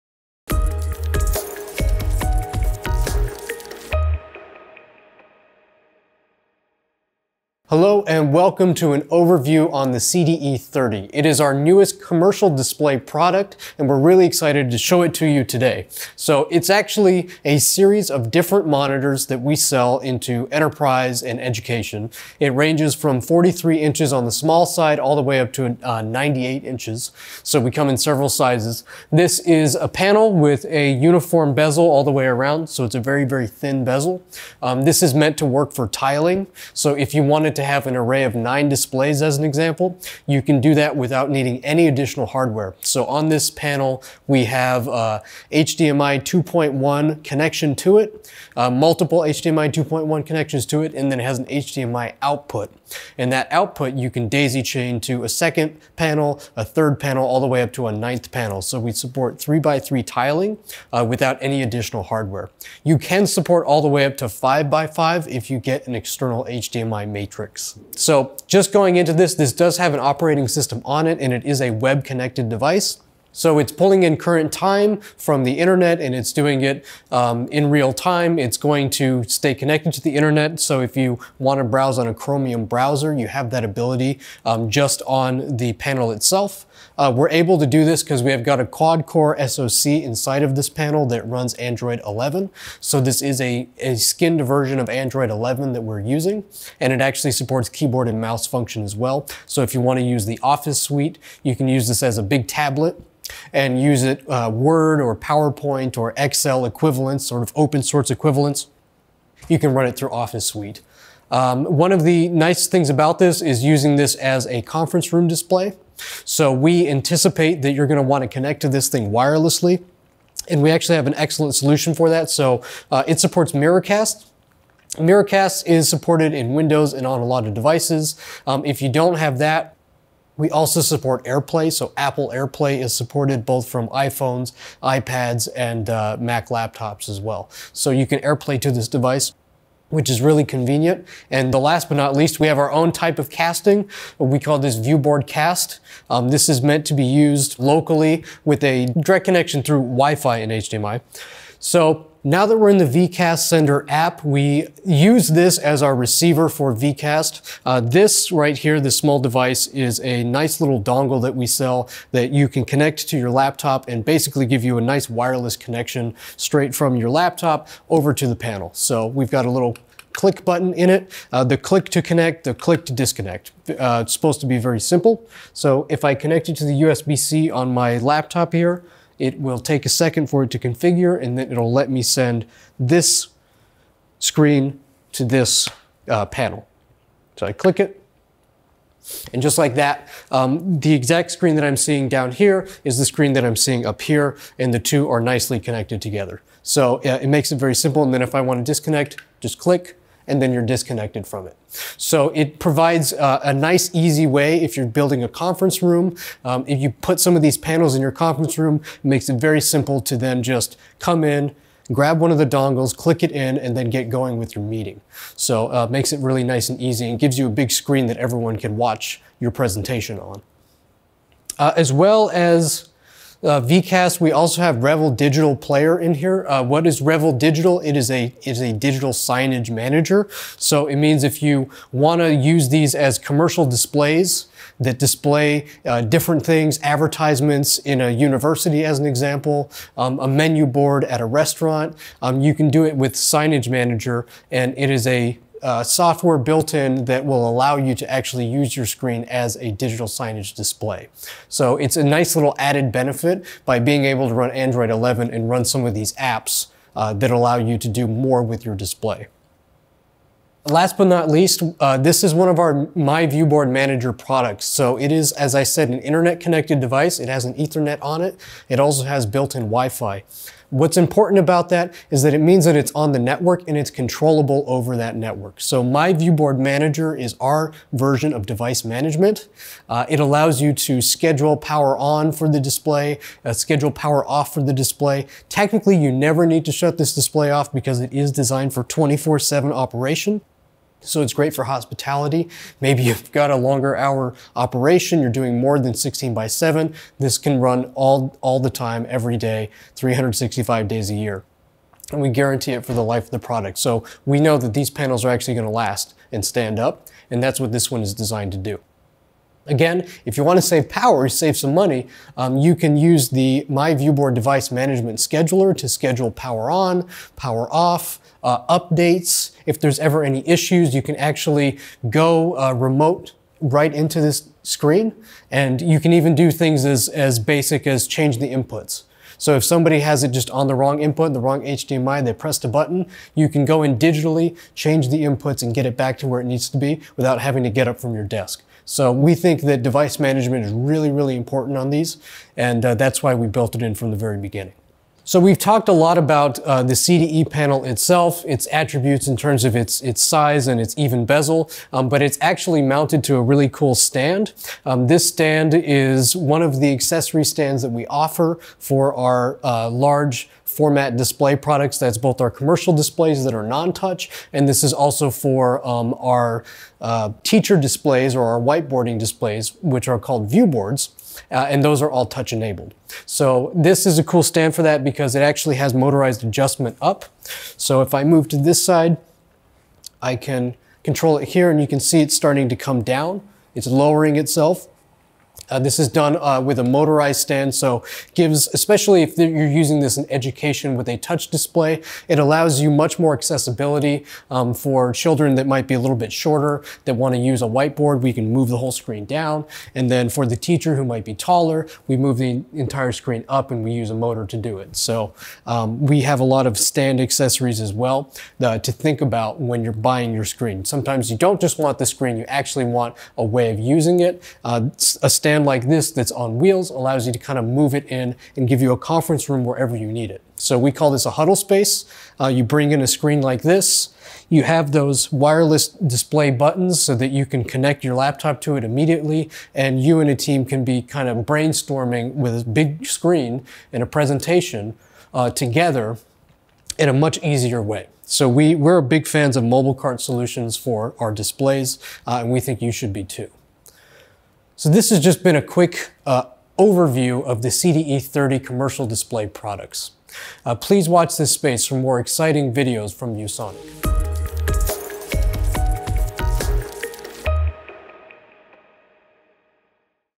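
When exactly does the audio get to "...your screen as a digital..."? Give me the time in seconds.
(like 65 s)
248 s.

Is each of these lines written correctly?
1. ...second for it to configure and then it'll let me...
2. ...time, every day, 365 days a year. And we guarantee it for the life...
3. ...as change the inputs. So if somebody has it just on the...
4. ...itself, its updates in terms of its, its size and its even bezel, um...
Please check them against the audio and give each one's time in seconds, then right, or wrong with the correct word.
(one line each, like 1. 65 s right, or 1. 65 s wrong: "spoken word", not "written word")
1. 179 s right
2. 298 s right
3. 327 s right
4. 347 s wrong: "attributes", not "updates".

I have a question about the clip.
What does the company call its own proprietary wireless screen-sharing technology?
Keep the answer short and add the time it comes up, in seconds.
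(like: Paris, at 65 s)
viewboard cast, at 144 s.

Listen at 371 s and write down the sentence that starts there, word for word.
Uh, and those are all touch enabled.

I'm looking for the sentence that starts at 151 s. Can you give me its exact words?
So now that we're in the vCast Sender app, we use this as our receiver for vCast.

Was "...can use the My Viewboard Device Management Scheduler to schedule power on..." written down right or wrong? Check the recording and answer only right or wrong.
right.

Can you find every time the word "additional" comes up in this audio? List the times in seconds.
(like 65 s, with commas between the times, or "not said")
41 s, 61 s.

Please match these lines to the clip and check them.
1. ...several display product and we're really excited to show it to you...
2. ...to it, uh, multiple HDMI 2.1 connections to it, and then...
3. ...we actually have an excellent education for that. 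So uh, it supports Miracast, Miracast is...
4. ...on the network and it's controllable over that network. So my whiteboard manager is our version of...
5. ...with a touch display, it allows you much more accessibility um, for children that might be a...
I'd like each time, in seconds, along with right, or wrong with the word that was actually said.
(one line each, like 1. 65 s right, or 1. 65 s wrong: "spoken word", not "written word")
1. 12 s wrong: "commercial", not "several"
2. 47 s right
3. 120 s wrong: "solution", not "education"
4. 272 s wrong: "viewboard", not "whiteboard"
5. 390 s right.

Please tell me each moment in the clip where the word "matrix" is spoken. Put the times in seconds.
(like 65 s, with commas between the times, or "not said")
67 s.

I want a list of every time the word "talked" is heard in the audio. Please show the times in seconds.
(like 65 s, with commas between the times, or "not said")
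345 s.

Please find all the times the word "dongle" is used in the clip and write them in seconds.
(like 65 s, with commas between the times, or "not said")
160 s, 212 s.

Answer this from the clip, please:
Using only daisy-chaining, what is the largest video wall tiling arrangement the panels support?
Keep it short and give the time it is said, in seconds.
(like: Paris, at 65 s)
3 by 3, at 59 s.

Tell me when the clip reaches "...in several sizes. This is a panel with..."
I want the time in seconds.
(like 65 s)
27 s.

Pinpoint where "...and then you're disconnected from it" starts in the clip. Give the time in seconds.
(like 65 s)
200 s.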